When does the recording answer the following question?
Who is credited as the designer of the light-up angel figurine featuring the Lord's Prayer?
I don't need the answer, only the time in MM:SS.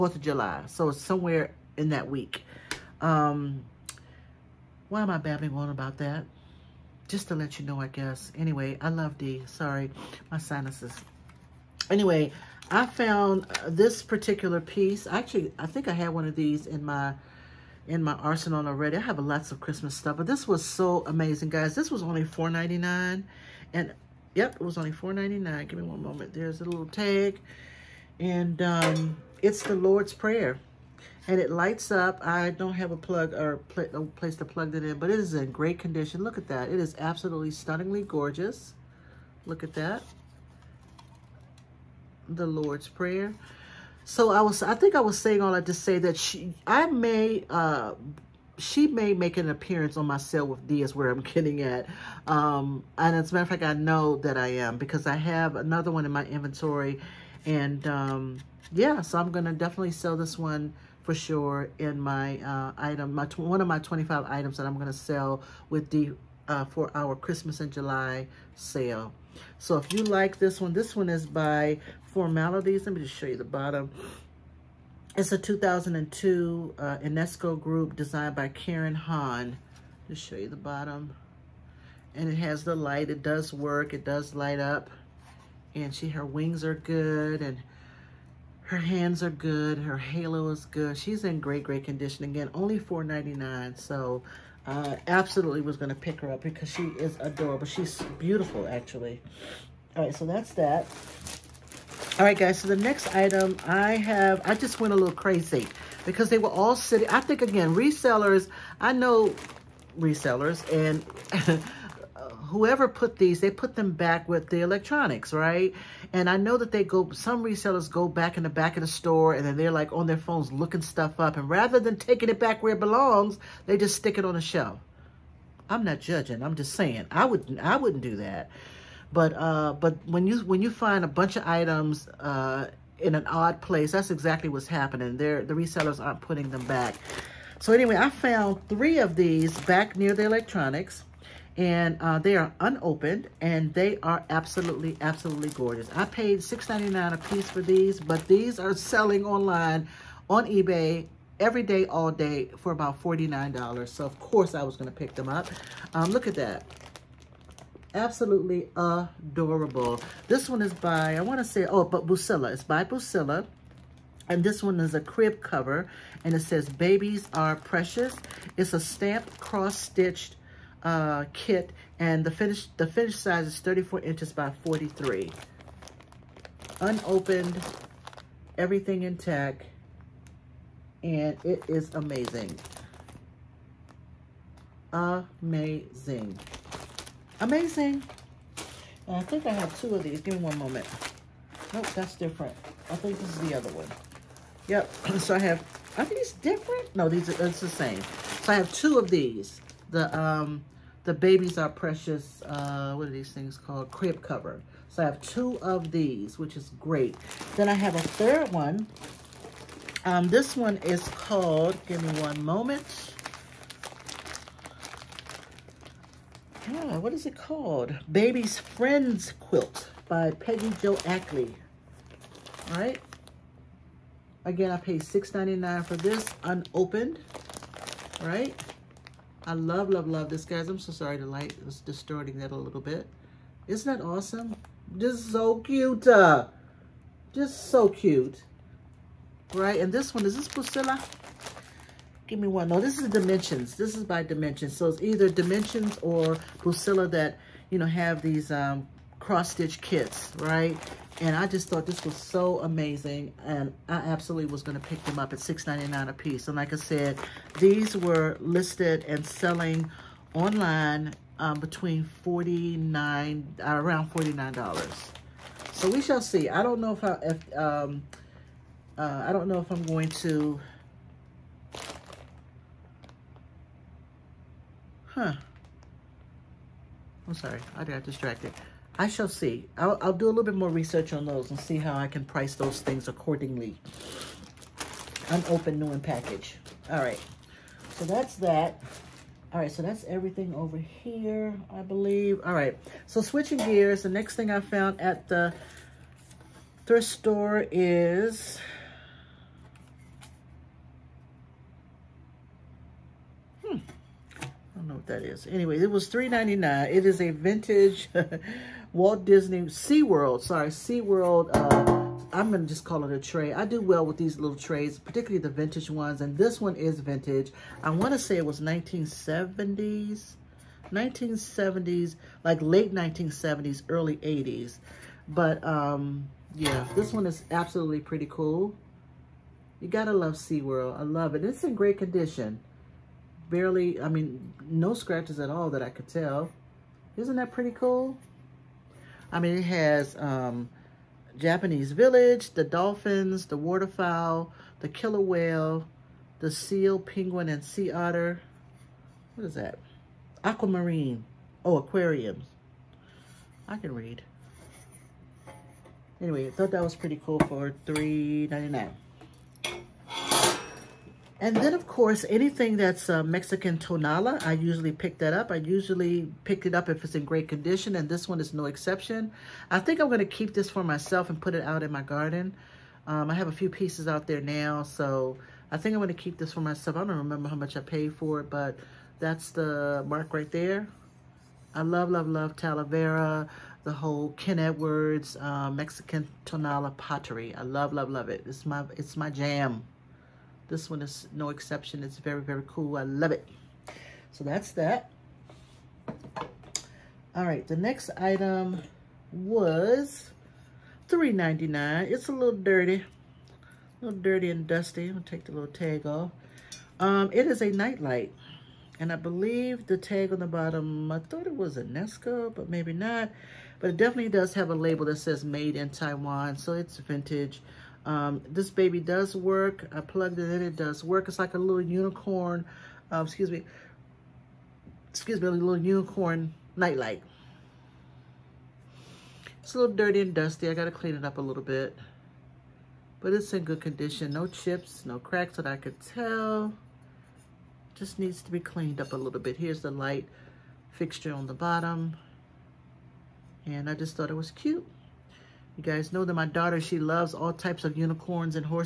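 01:18.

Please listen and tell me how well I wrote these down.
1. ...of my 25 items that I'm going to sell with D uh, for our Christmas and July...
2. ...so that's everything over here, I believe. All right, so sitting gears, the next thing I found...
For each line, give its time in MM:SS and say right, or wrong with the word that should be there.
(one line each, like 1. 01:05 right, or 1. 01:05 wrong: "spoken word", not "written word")
1. 01:03 right
2. 04:49 wrong: "switching", not "sitting".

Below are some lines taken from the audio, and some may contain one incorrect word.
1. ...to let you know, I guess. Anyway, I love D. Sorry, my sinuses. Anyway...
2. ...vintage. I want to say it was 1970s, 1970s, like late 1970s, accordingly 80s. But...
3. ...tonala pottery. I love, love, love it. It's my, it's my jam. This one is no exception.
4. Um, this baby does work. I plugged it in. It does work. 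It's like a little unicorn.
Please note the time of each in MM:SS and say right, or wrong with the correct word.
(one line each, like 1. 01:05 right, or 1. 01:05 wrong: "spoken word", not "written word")
1. 00:07 right
2. 05:16 wrong: "early", not "accordingly"
3. 06:26 right
4. 06:58 right.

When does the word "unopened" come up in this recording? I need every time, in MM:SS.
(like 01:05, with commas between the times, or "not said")
02:22, 02:56, 03:46, 04:45.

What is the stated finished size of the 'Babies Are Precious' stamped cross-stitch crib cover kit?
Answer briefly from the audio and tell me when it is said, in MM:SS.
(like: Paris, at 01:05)
34 inches by 43, at 02:53.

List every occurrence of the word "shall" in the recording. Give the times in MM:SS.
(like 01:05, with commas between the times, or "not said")
04:25, 04:39.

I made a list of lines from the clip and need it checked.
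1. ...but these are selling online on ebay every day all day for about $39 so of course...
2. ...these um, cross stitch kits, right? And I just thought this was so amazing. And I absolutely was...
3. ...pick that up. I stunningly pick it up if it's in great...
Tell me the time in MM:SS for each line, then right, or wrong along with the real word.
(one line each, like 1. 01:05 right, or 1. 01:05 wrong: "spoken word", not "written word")
1. 02:27 wrong: "49", not "39"
2. 04:08 right
3. 06:04 wrong: "usually", not "stunningly".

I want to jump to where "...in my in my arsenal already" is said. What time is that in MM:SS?
00:16.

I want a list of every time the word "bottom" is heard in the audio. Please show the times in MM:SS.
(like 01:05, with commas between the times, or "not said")
01:13, 01:20, 06:50, 07:21.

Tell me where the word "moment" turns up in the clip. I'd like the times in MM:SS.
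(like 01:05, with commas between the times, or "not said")
00:26, 03:10, 03:32.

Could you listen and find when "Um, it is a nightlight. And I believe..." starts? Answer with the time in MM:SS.
06:46.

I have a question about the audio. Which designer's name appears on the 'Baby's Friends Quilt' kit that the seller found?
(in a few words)
Peggy Jo Ackley.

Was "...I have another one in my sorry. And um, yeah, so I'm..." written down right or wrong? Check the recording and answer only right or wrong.
wrong.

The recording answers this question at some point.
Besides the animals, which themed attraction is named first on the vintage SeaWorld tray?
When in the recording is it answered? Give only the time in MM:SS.
05:41.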